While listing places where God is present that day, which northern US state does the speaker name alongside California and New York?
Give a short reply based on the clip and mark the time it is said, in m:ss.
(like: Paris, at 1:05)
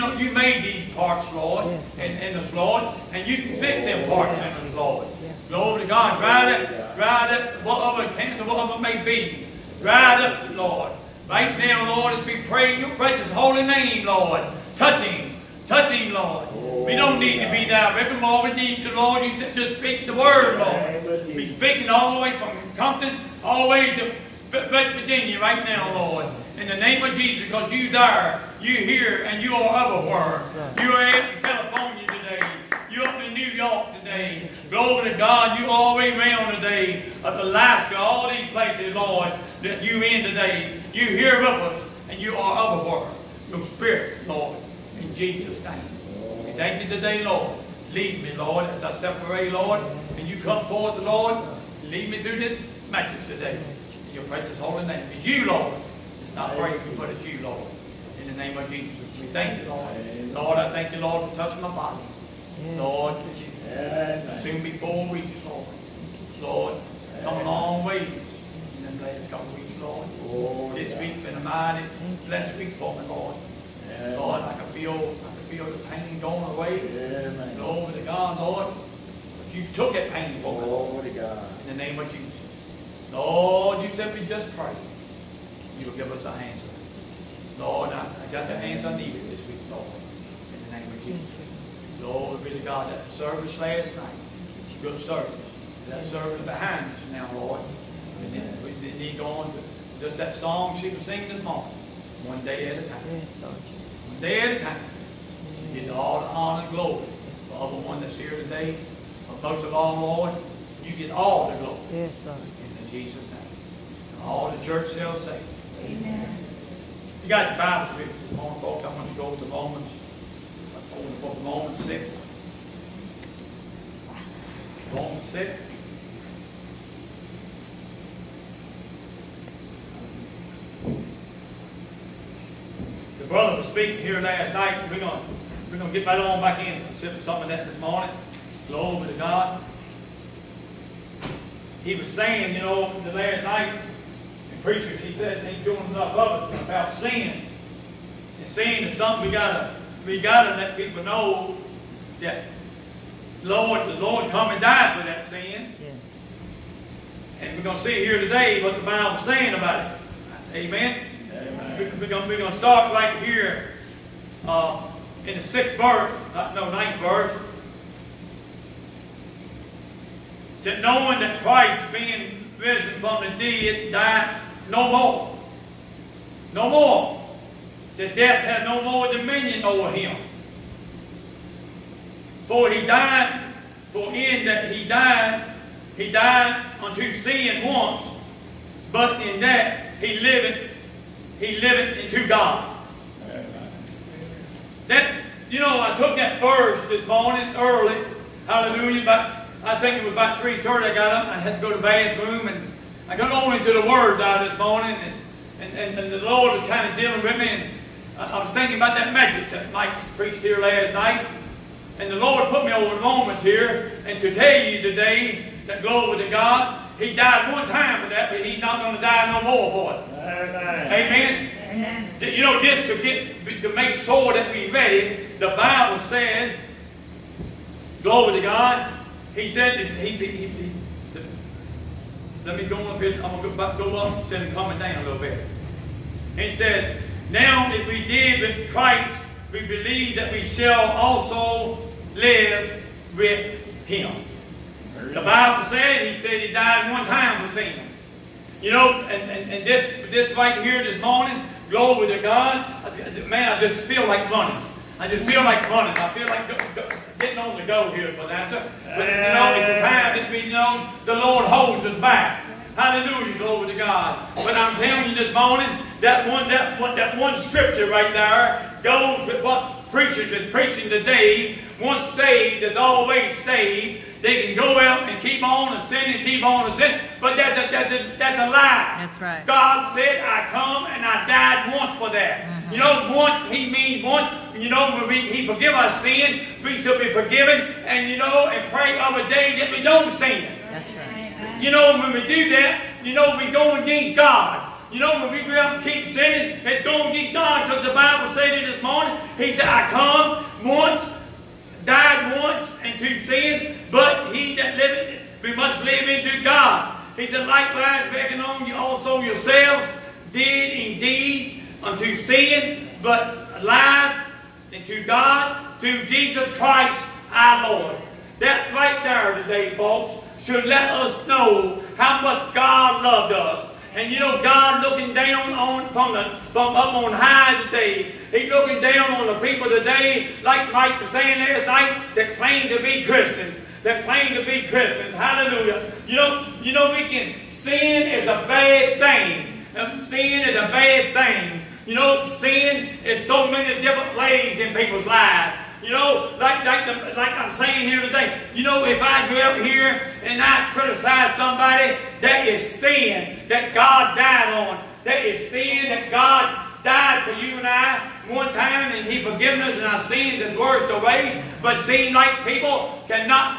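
Alaska, at 0:37.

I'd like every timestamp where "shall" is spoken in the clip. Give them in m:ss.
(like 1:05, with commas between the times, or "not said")
1:54, 4:00, 4:46.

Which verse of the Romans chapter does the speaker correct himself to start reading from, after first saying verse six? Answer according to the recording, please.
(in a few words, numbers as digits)
9.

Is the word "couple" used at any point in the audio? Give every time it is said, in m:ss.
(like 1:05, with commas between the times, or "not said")
1:09.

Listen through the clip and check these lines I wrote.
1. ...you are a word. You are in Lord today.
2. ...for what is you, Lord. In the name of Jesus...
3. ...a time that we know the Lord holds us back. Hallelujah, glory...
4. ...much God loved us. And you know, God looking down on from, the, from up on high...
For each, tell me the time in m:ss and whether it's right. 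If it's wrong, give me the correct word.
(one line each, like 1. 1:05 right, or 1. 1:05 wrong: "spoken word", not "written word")
1. 0:29 wrong: "California", not "Lord"
2. 0:56 right
3. 4:19 right
4. 5:22 right.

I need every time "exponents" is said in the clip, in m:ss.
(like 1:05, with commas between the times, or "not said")
not said.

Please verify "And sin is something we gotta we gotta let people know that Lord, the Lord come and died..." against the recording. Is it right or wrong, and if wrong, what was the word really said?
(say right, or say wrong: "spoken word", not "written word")
right.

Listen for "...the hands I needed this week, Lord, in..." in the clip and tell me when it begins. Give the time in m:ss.
1:28.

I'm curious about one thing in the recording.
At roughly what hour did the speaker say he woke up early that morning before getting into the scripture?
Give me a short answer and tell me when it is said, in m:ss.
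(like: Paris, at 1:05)
3:30, at 3:20.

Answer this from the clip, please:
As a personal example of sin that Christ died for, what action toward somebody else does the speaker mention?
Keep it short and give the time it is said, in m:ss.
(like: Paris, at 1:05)
criticize somebody, at 5:50.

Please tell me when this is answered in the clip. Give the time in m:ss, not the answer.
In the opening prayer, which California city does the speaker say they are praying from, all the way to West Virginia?
0:22.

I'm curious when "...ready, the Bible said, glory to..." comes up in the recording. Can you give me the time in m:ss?
3:44.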